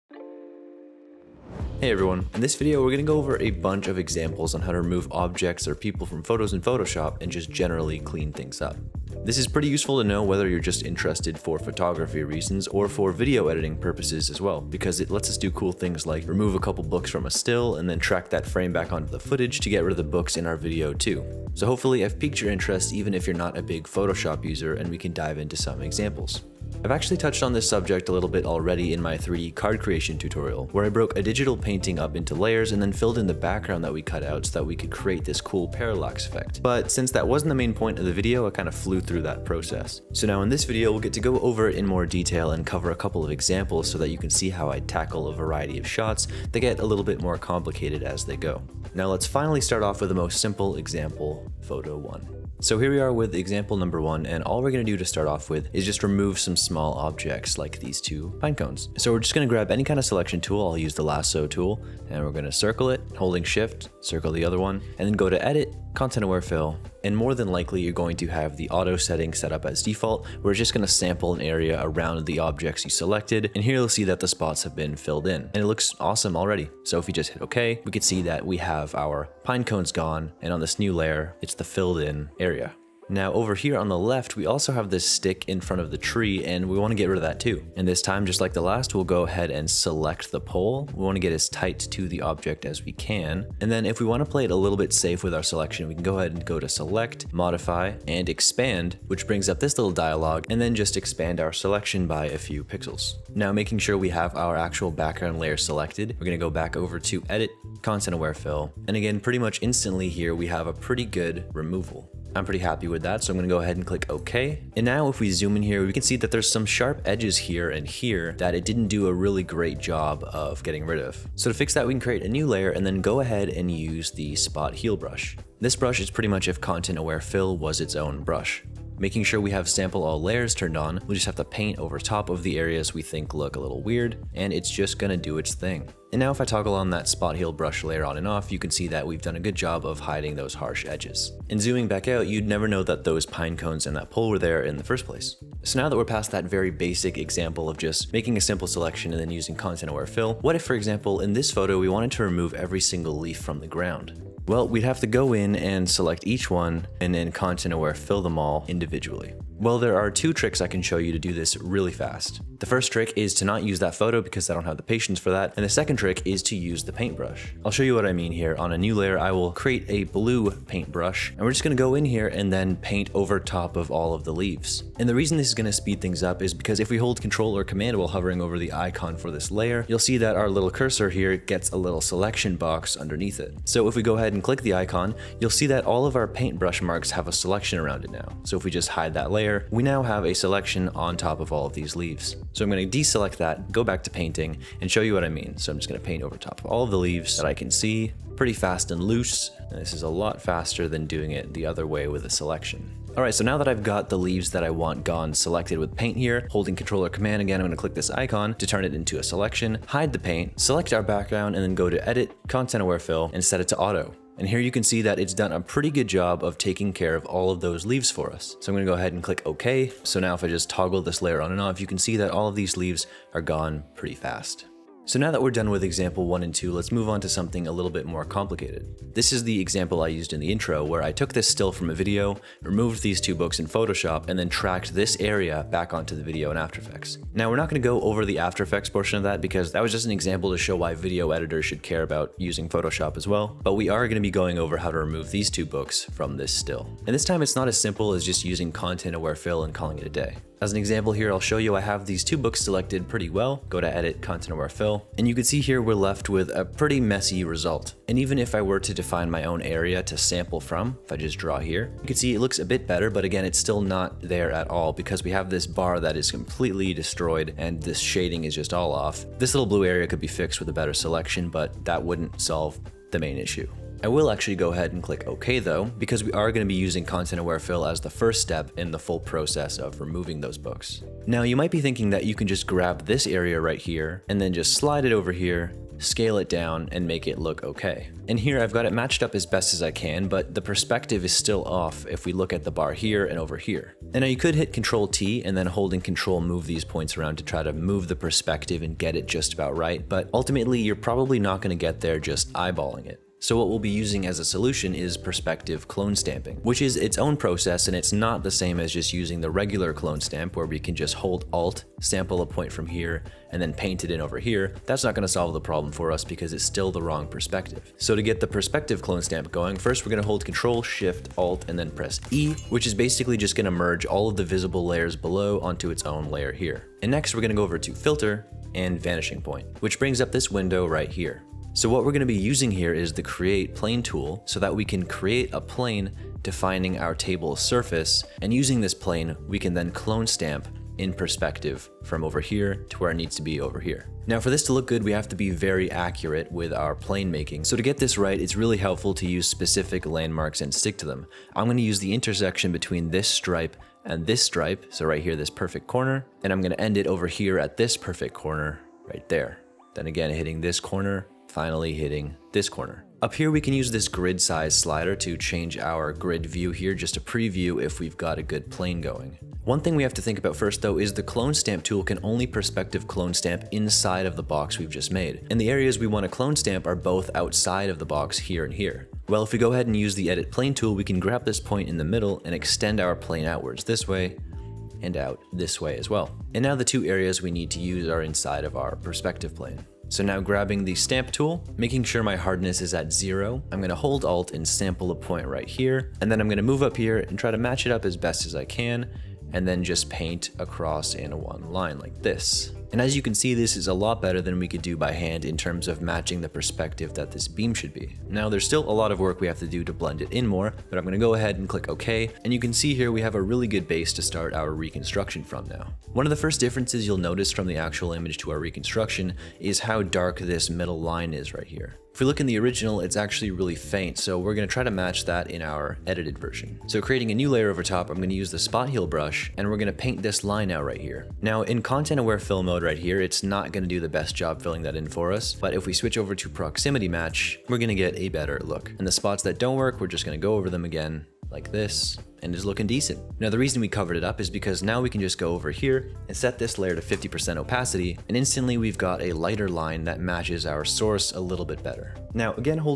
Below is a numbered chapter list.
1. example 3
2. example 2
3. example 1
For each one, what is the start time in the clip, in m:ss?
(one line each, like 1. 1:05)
1. 3:44
2. 2:24
3. 0:52.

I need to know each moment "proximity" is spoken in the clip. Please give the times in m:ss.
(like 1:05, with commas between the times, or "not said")
7:16.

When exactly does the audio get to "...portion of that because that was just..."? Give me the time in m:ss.
3:58.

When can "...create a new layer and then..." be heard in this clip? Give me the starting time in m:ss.
2:01.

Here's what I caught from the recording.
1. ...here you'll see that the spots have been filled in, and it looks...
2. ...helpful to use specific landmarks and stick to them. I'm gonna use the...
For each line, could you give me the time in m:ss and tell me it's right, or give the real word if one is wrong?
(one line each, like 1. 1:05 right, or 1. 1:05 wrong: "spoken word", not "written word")
1. 1:13 right
2. 5:48 right.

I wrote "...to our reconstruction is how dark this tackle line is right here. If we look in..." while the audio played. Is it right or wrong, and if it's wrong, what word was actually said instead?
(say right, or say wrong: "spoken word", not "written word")
wrong: "middle", not "tackle".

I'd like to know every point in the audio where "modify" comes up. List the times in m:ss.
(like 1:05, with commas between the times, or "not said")
1:37.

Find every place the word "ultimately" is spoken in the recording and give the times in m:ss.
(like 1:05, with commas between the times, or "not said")
5:00.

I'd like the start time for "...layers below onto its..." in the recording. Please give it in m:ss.
5:24.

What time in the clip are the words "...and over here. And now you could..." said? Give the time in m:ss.
4:53.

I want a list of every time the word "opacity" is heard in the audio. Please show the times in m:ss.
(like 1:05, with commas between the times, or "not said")
7:27.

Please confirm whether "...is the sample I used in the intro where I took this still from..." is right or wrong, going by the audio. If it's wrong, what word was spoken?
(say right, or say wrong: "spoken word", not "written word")
wrong: "example", not "sample".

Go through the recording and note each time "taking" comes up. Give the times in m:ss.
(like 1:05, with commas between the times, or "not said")
3:36.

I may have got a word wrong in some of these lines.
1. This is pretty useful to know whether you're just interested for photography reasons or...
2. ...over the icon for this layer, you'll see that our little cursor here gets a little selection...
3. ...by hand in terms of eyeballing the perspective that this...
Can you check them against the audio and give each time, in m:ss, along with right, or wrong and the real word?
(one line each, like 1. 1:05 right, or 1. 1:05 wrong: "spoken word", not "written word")
1. 0:09 right
2. 2:58 right
3. 6:44 wrong: "matching", not "eyeballing".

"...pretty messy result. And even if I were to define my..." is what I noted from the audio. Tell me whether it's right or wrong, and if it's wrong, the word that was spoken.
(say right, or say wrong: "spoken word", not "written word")
right.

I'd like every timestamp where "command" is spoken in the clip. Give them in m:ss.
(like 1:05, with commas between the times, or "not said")
2:57, 3:27.